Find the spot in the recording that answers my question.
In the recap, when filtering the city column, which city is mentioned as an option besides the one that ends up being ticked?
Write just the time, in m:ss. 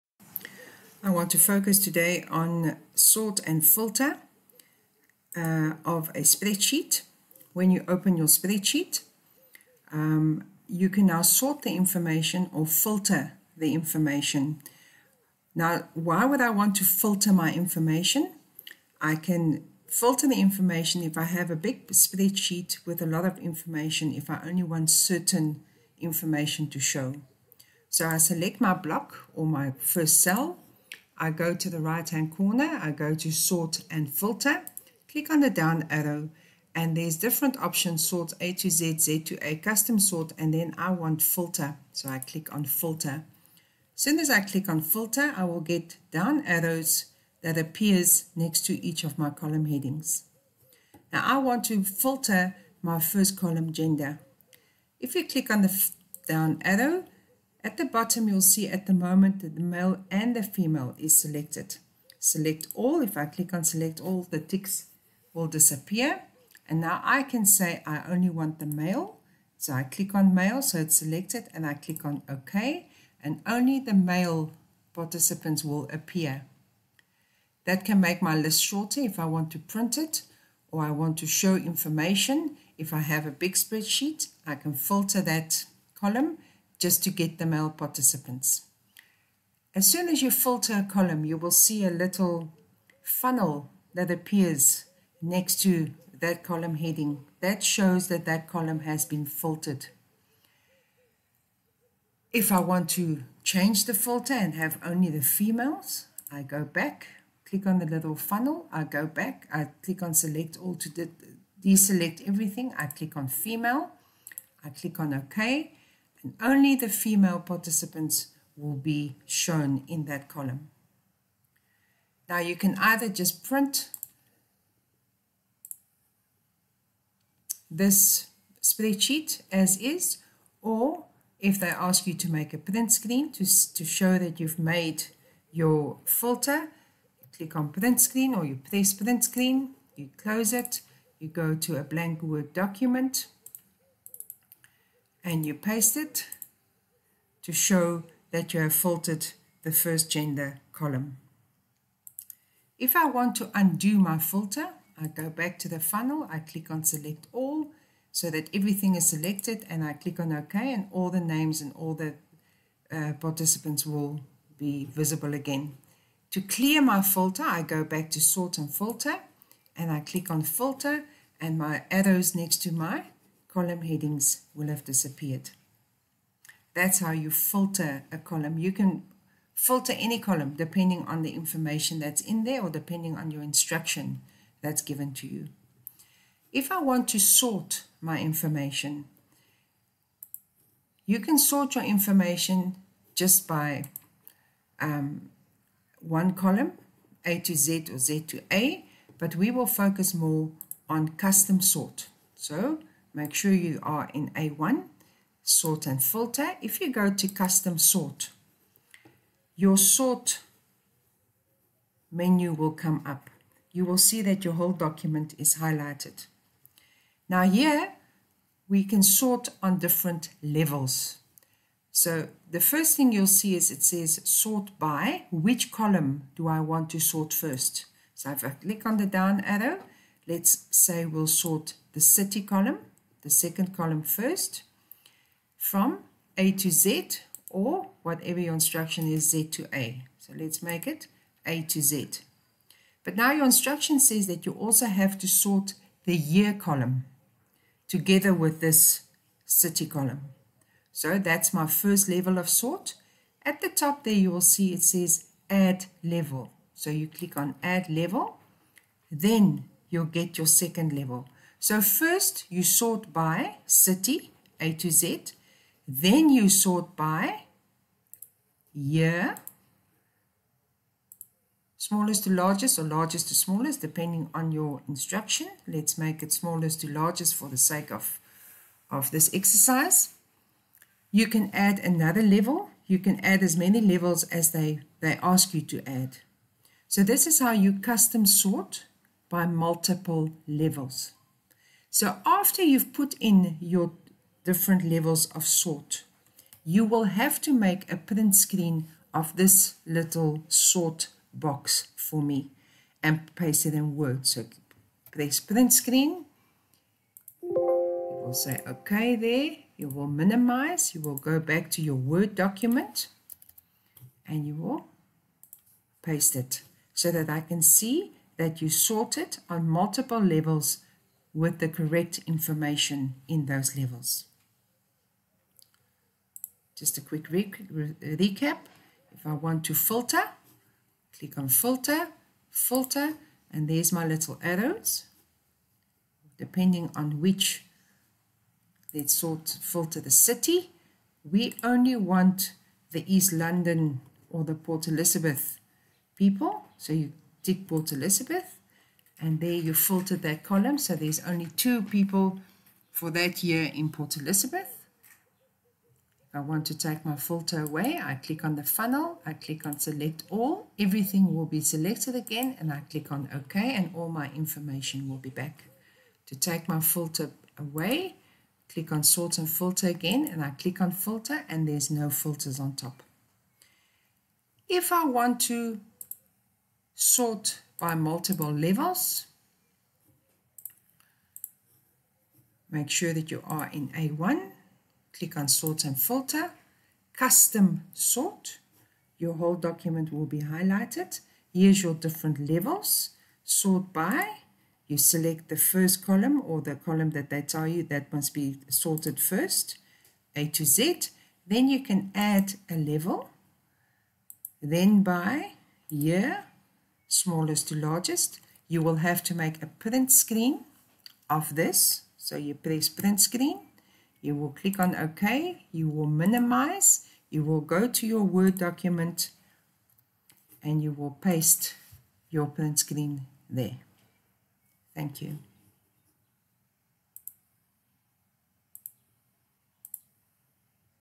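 5:43.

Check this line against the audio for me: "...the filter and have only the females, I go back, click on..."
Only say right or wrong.
right.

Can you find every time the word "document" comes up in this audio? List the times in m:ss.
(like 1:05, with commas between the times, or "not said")
2:22, 3:34, 5:12, 6:29, 6:58.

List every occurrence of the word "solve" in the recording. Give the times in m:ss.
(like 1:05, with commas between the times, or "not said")
not said.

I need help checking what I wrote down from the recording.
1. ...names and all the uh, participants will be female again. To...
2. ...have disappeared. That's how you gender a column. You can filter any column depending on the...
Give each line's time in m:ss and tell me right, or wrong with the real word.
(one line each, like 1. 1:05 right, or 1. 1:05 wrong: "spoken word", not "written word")
1. 2:41 wrong: "visible", not "female"
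2. 2:54 wrong: "filter", not "gender".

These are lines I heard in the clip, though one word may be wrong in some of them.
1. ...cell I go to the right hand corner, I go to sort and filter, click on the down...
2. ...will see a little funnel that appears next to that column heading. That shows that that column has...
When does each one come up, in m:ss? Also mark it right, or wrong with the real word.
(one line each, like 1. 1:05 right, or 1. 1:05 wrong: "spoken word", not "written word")
1. 0:30 right
2. 1:31 right.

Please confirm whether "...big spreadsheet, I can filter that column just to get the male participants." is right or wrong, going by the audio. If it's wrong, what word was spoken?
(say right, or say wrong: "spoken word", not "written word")
right.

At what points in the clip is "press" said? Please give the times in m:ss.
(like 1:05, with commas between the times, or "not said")
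2:18, 5:05, 6:52.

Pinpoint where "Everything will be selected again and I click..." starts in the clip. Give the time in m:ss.
6:00.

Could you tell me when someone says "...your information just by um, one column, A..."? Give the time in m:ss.
3:11.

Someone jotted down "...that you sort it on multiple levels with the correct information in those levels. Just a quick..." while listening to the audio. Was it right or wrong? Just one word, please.
right.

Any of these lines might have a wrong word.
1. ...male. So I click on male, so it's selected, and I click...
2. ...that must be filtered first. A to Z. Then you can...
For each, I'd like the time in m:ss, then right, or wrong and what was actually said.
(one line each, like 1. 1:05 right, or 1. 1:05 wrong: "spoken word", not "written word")
1. 1:08 right
2. 6:37 wrong: "sorted", not "filtered".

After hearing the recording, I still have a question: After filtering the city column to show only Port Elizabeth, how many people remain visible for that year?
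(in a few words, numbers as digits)
2.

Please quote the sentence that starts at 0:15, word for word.
Now, why would I want to filter my information?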